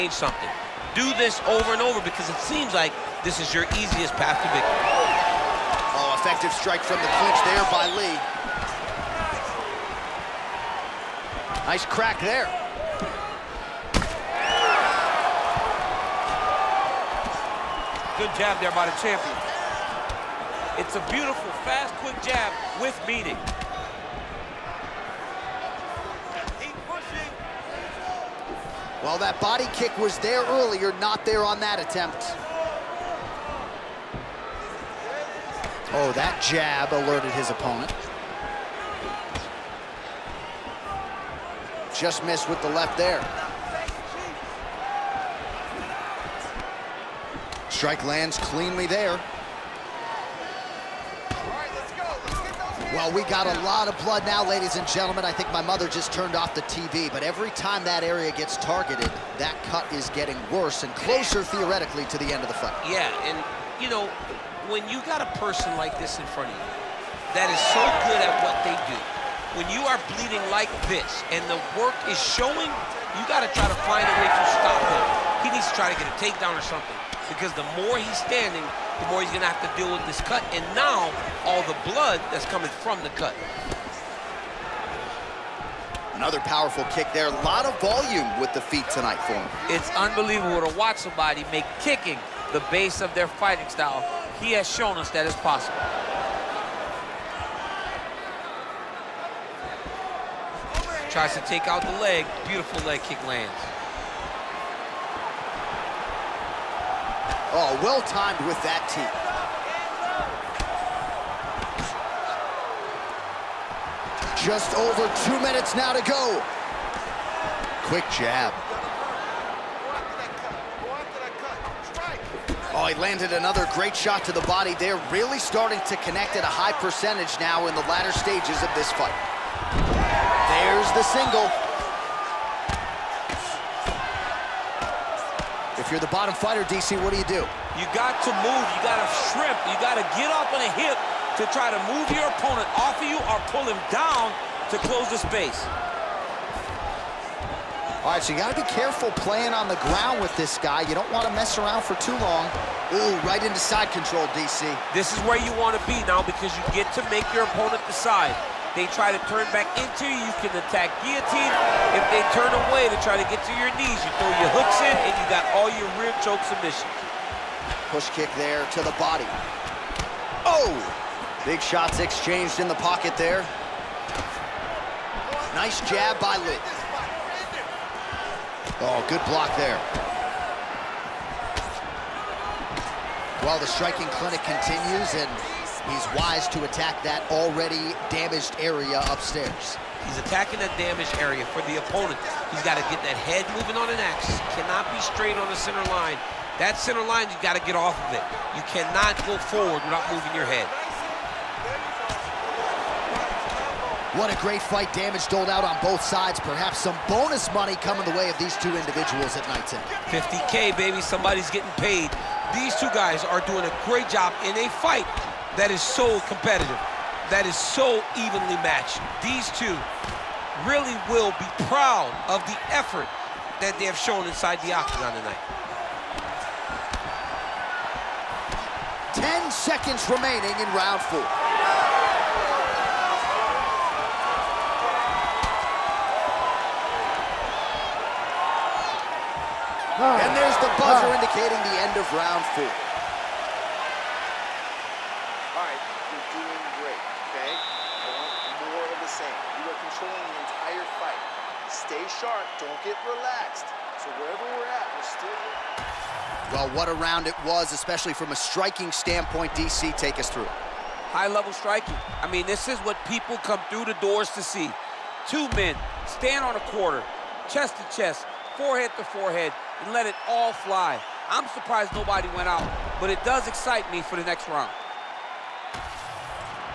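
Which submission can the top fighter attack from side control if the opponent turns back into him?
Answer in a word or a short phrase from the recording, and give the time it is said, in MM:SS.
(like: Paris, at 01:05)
Guillotine, at 02:41.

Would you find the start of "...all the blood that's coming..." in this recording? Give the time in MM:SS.
01:21.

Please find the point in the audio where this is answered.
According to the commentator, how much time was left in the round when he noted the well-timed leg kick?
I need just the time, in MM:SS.
01:54.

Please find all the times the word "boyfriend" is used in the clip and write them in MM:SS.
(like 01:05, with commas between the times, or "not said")
not said.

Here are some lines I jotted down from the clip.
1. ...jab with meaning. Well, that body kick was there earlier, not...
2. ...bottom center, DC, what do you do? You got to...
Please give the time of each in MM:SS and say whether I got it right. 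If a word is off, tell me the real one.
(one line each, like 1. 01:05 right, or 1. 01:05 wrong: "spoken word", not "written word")
1. 00:22 right
2. 02:16 wrong: "fighter", not "center".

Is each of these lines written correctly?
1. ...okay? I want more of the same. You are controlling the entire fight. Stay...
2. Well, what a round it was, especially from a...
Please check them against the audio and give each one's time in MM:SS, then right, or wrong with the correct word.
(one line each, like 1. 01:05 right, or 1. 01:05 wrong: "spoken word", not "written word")
1. 04:07 right
2. 04:16 right.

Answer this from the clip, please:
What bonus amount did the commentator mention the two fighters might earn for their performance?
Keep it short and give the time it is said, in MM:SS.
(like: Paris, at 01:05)
50K, at 03:30.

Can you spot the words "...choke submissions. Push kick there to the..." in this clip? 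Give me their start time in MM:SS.
02:46.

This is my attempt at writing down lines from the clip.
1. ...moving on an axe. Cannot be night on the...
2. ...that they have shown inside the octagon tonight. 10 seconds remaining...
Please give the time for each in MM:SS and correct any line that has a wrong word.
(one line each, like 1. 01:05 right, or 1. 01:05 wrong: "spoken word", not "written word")
1. 03:13 wrong: "straight", not "night"
2. 03:43 right.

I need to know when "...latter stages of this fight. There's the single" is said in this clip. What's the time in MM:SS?
02:07.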